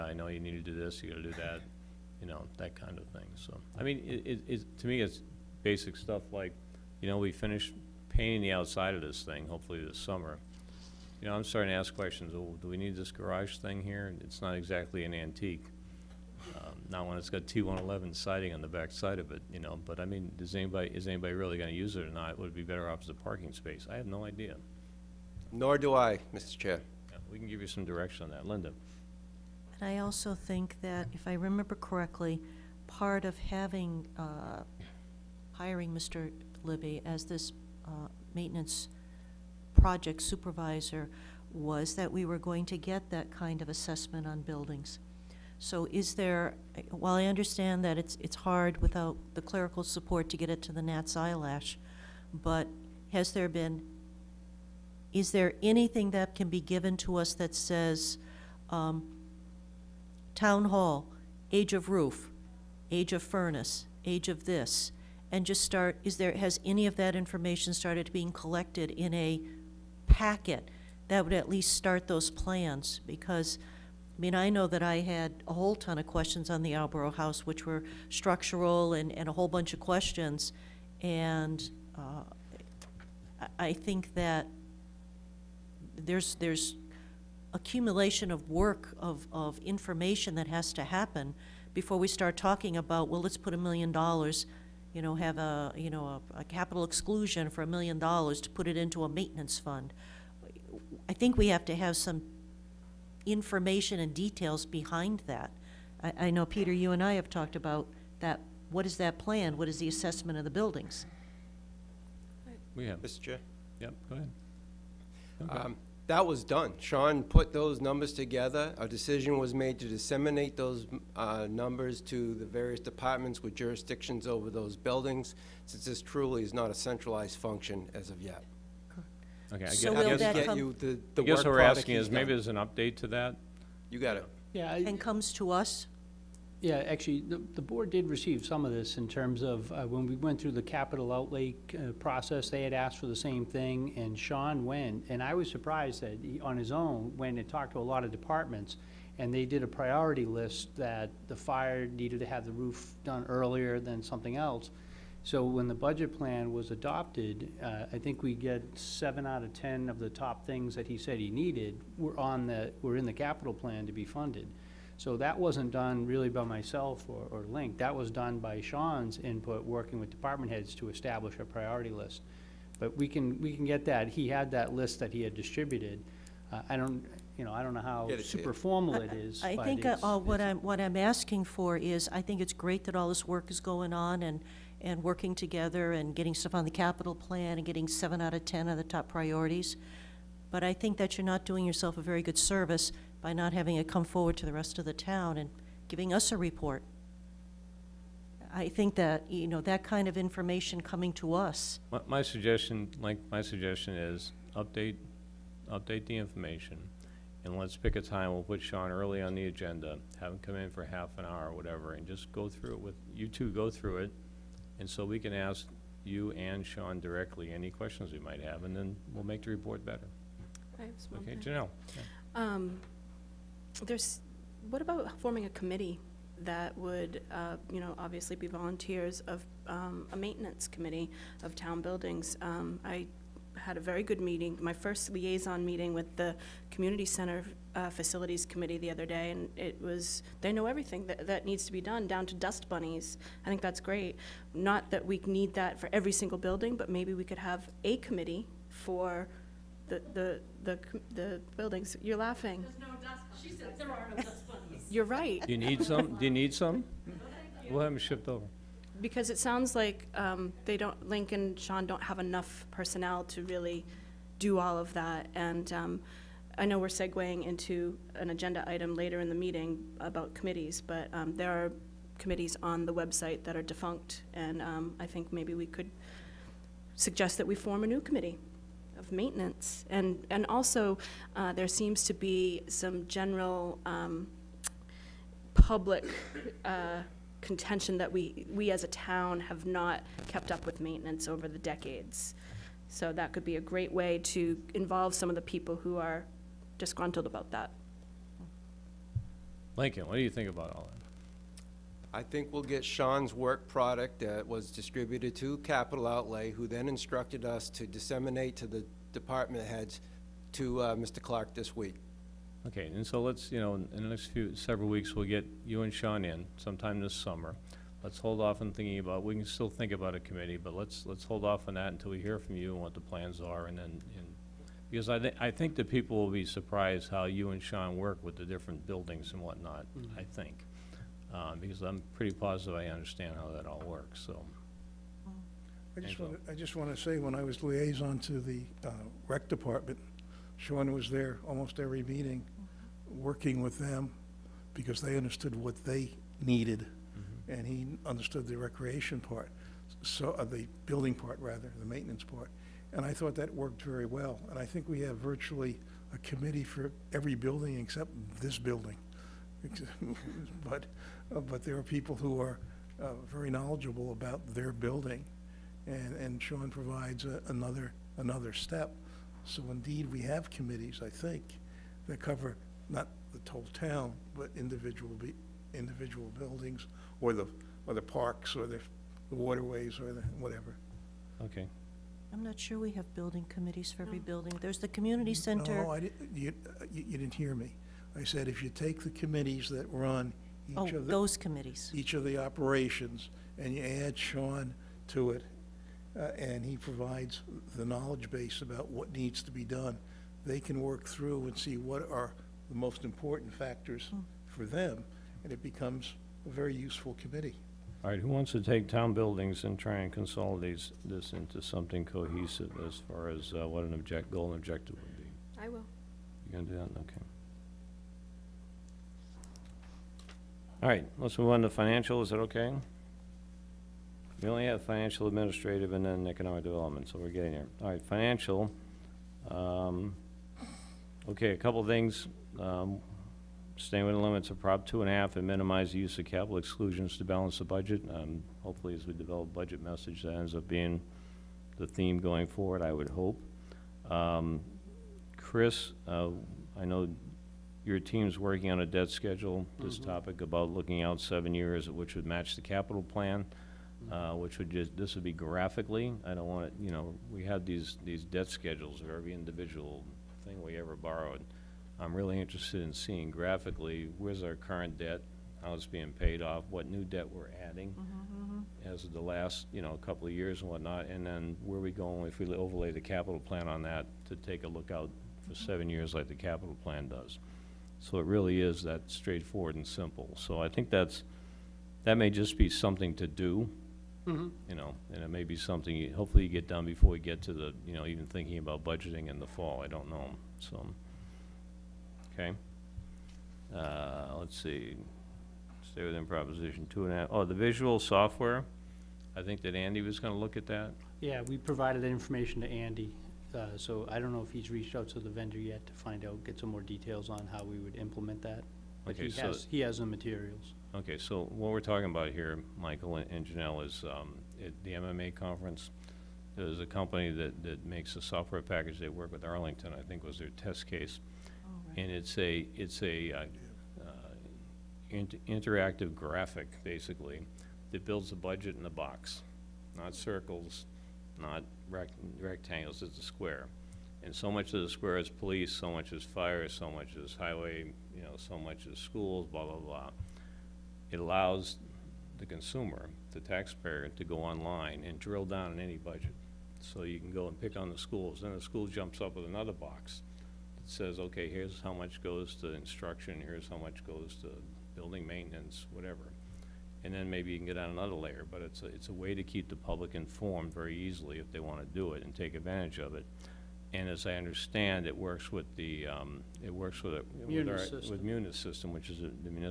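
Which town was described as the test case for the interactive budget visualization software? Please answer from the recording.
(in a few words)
Arlington.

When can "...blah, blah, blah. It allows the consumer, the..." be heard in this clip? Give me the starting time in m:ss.
8:59.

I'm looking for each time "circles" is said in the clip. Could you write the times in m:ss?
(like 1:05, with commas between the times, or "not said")
8:50.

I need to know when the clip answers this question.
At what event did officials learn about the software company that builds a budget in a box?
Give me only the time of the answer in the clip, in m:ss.
8:34.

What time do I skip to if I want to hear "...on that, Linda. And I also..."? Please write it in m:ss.
0:28.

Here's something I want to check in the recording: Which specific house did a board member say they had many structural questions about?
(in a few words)
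Albro House.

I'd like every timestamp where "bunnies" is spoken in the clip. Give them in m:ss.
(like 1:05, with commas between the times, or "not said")
4:02, 4:14.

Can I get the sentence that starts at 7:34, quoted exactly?
uh, which would just, this would be graphically.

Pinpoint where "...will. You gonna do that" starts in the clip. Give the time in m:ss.
6:55.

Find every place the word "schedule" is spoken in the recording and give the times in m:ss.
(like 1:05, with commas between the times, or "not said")
7:29, 7:38.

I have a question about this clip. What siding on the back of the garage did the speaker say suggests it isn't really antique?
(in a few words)
T111.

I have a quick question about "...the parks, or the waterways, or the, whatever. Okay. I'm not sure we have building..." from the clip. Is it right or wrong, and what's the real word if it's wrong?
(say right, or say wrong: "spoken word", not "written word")
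right.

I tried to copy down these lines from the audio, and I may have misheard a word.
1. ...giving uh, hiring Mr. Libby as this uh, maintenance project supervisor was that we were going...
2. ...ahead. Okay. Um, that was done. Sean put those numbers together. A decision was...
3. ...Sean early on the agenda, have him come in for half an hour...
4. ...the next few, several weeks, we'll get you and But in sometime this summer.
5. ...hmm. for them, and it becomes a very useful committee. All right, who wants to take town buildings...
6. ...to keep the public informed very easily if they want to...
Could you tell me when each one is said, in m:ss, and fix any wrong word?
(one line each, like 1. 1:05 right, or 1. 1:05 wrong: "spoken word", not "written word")
1. 0:33 wrong: "having", not "giving"
2. 1:54 right
3. 3:28 right
4. 5:13 wrong: "Sean", not "But"
5. 6:44 right
6. 9:19 right.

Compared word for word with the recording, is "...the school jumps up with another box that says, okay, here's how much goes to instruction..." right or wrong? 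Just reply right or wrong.
right.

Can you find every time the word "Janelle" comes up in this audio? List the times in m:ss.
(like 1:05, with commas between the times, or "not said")
3:41, 8:33.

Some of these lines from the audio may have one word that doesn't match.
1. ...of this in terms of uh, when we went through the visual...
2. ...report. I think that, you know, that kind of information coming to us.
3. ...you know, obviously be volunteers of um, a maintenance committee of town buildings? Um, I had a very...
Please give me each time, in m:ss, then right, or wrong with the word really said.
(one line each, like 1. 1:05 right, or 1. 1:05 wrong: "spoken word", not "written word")
1. 2:18 wrong: "capital", not "visual"
2. 3:16 right
3. 3:47 right.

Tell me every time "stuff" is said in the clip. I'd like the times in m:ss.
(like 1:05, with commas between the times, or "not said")
0:05, 3:06.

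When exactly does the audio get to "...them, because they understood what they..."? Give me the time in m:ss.
5:43.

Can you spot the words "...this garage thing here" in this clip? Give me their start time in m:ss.
0:12.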